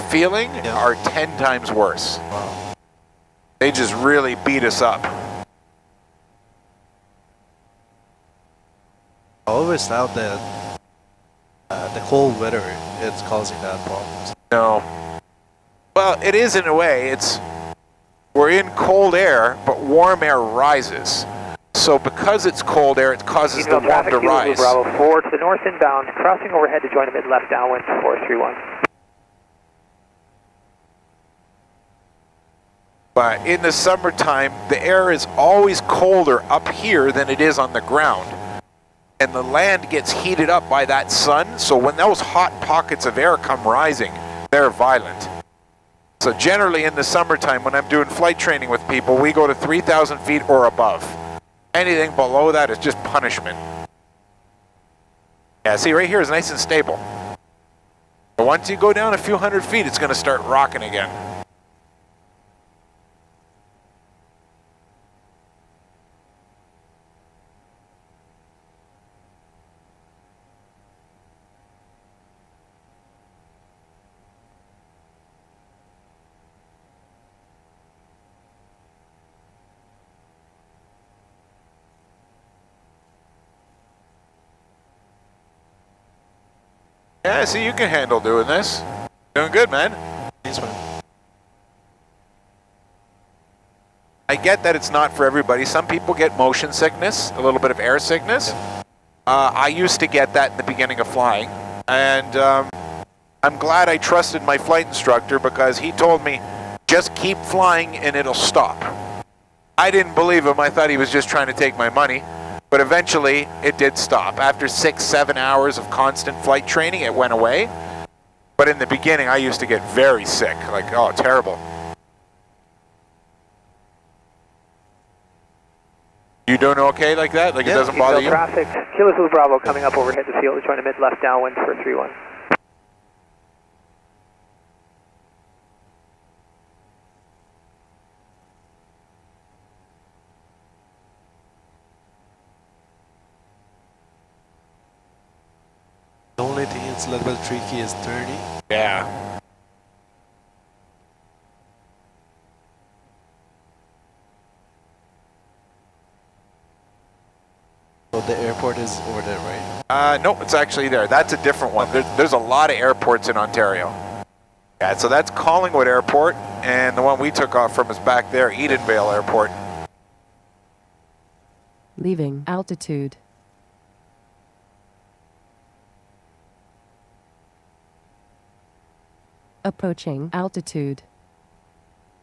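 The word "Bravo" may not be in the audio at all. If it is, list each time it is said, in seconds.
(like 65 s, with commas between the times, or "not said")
24 s, 129 s.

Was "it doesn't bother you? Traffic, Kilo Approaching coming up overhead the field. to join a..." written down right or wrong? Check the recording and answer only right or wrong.
wrong.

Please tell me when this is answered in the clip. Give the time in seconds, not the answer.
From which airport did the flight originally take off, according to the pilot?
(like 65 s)
168 s.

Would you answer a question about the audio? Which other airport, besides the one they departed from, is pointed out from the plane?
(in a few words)
Collingwood Airport.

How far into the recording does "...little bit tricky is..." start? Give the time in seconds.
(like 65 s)
147 s.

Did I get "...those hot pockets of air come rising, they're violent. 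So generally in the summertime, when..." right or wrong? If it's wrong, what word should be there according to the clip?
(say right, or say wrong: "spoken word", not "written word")
right.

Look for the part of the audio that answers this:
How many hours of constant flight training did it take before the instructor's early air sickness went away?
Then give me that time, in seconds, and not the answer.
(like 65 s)
114 s.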